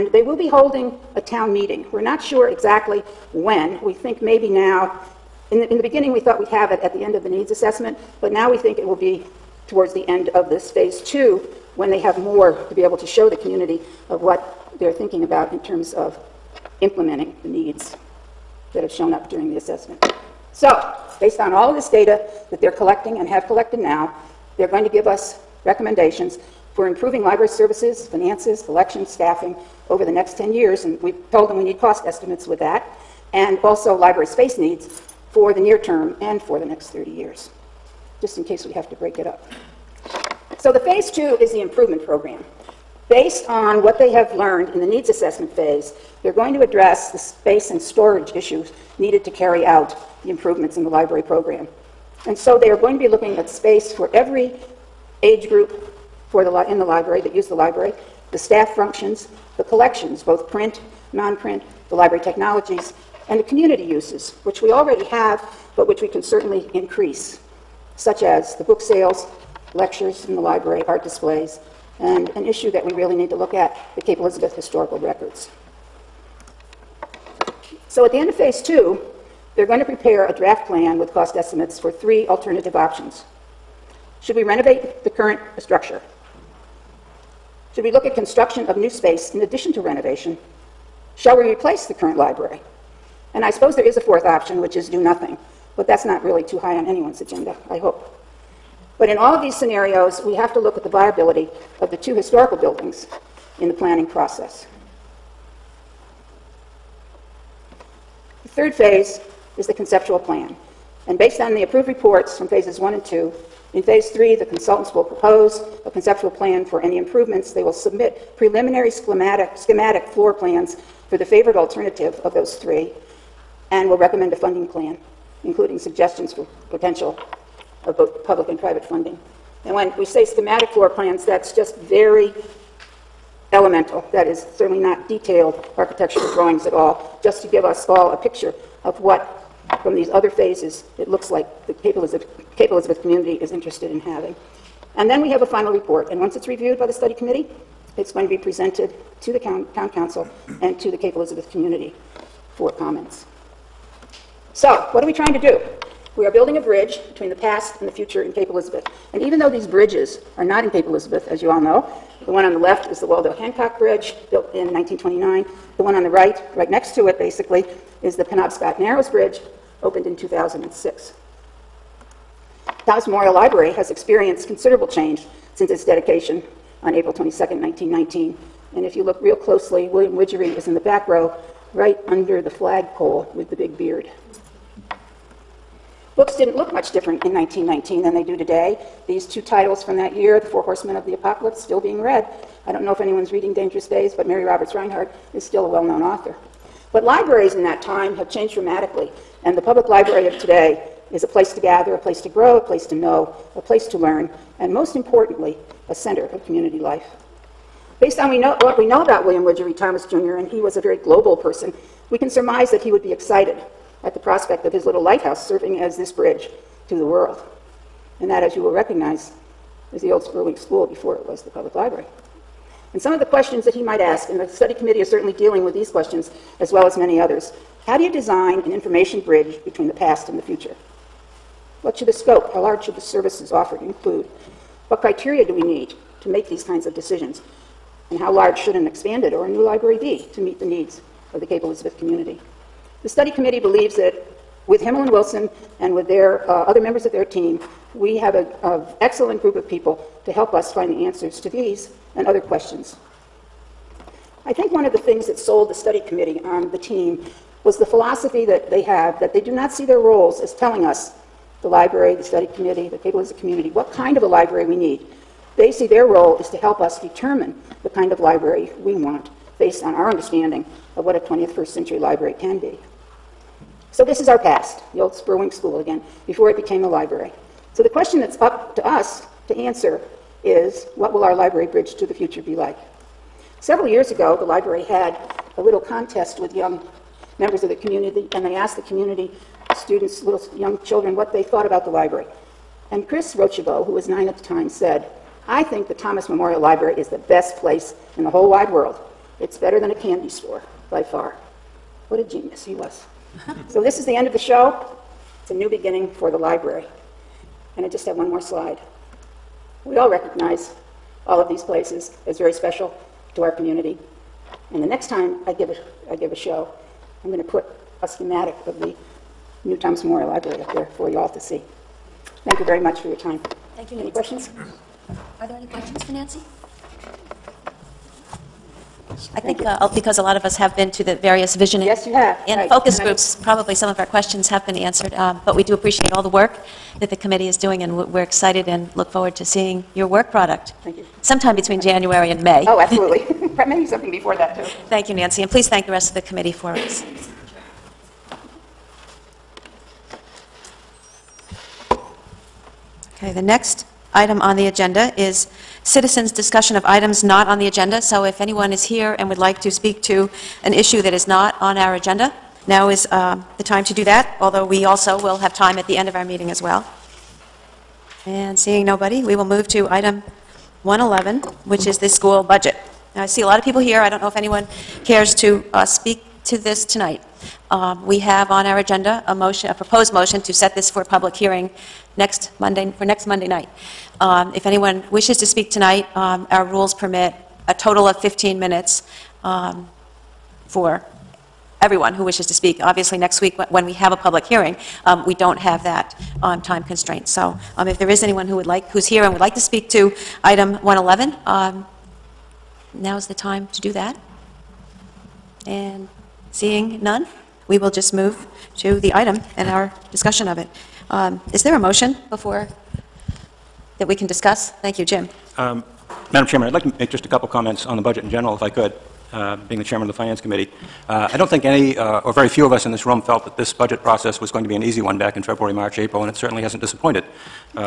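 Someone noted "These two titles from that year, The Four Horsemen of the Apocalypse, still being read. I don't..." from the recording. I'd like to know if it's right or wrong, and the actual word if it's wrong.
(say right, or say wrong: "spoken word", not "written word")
right.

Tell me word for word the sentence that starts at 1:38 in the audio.
But in all of these scenarios, we have to look at the viability of the two historical buildings in the planning process.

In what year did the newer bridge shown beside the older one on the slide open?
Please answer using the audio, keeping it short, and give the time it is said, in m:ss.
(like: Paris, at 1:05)
2006, at 2:50.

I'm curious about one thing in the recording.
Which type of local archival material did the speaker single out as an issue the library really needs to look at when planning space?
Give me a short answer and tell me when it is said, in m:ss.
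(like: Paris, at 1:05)
Cape Elizabeth historical records, at 1:13.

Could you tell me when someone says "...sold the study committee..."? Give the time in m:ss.
4:15.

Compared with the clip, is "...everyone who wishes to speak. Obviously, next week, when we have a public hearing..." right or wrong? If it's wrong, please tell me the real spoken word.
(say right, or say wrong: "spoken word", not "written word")
right.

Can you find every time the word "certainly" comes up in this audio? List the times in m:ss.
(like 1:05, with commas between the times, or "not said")
1:06, 2:14, 3:45, 7:06.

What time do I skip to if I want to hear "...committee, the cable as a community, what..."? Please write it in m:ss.
4:22.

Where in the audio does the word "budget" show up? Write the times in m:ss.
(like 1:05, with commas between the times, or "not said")
6:12, 6:57, 7:03.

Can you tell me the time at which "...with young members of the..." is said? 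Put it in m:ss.
4:46.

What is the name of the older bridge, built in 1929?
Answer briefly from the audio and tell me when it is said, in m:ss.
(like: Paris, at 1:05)
Waldo Hancock Bridge, at 2:43.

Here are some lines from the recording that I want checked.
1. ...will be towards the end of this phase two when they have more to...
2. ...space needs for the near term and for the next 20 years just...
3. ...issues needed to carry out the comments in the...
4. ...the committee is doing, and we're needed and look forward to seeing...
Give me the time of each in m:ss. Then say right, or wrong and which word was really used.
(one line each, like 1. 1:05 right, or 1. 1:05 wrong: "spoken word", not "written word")
1. 0:08 right
2. 0:34 wrong: "30", not "20"
3. 0:48 wrong: "improvements", not "comments"
4. 5:37 wrong: "excited", not "needed".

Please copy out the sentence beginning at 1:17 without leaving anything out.
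So at the end of phase two, they're going to prepare a draft plan with cost estimates for three alternative options.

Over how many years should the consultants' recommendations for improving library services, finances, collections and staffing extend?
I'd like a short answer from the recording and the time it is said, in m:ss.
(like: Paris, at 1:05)
10 years, at 0:30.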